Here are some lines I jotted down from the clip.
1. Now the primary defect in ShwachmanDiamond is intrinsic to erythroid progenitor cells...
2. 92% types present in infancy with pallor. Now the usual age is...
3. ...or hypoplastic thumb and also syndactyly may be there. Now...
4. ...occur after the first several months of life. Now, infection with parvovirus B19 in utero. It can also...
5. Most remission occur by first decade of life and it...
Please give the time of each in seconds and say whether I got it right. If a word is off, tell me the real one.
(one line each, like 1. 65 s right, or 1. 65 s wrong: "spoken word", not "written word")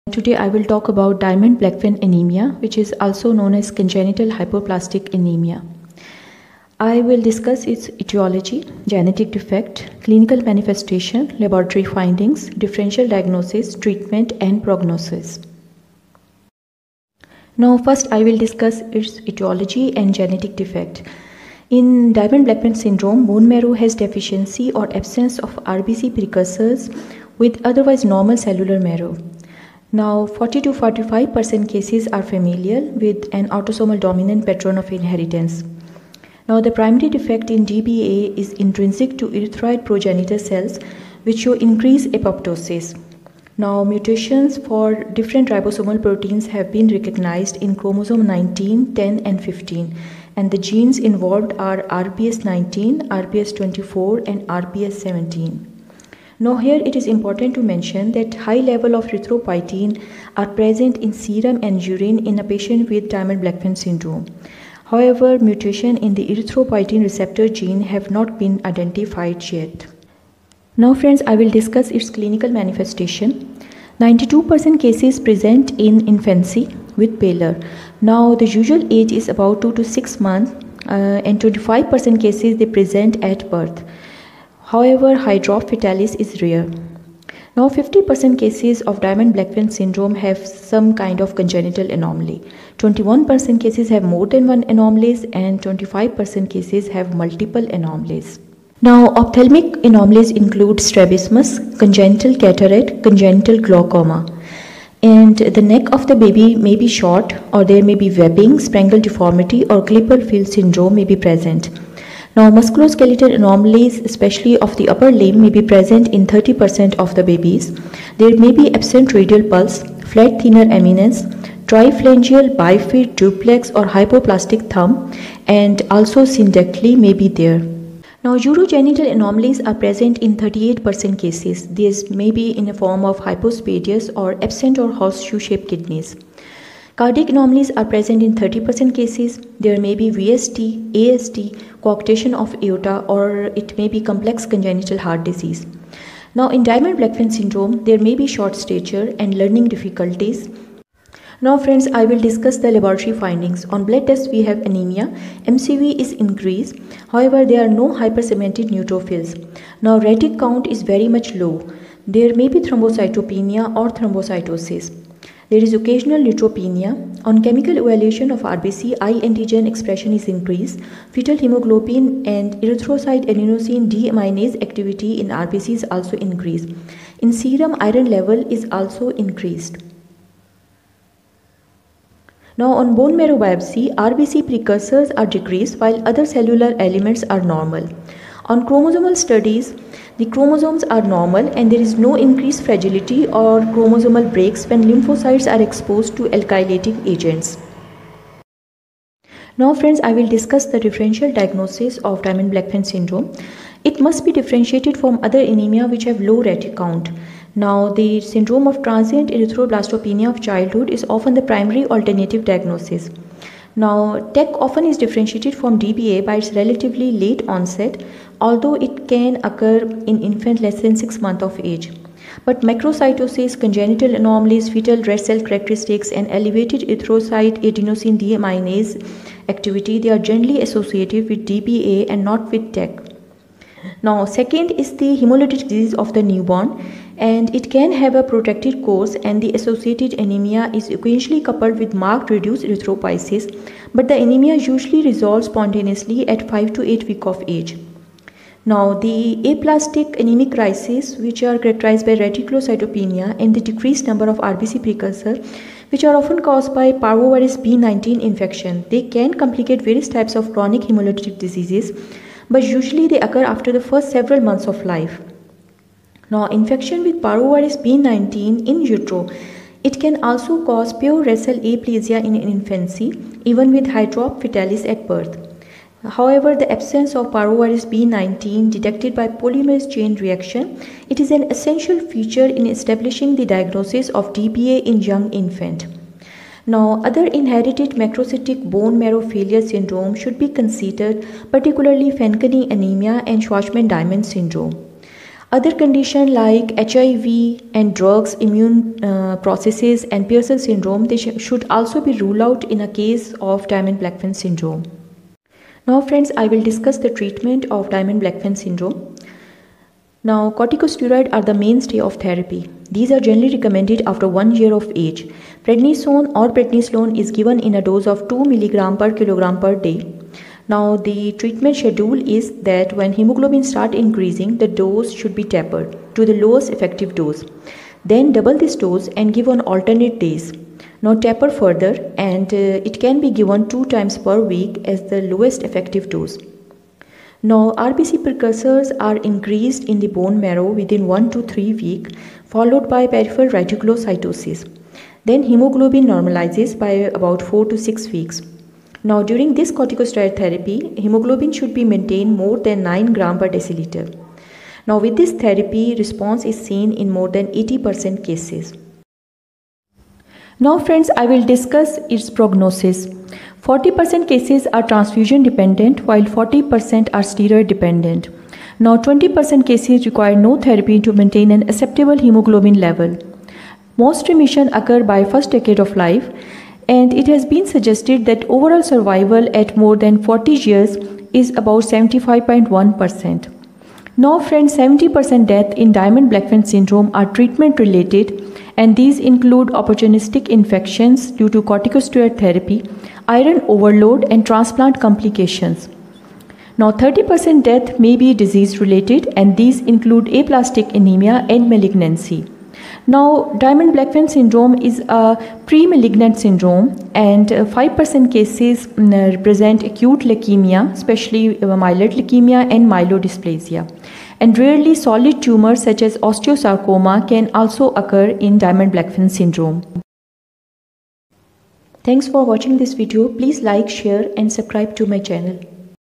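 1. 36 s wrong: "DBA", not "ShwachmanDiamond"
2. 73 s wrong: "cases", not "types"
3. 123 s right
4. 263 s right
5. 373 s right.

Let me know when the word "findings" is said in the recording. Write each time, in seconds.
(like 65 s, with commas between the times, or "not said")
11 s, 153 s.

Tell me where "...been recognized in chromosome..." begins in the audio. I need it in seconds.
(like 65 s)
46 s.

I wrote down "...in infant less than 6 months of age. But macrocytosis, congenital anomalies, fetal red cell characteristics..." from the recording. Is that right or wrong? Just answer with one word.
right.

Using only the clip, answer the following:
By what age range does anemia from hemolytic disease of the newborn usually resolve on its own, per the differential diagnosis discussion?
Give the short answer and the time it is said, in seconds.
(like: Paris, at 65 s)
5 to 8 weeks, at 246 s.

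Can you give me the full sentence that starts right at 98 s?
Now, ophthalmic anomalies include strabismus, congenital cataract, congenital glaucoma.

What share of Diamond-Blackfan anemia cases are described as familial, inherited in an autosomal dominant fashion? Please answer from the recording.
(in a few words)
40 to 45%.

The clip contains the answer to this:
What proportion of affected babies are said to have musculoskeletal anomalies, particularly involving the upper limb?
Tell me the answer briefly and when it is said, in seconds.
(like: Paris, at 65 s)
30%, at 116 s.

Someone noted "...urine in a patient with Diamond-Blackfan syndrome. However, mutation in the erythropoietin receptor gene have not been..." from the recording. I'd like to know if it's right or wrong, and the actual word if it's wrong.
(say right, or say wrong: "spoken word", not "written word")
right.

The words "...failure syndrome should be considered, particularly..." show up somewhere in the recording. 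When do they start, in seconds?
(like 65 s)
289 s.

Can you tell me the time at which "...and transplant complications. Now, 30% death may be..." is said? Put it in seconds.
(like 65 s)
394 s.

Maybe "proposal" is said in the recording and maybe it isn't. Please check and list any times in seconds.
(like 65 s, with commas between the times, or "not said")
not said.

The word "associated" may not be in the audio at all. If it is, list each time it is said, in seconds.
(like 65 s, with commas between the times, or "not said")
230 s, 239 s.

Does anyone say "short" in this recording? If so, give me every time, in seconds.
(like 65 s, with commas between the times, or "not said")
106 s, 148 s.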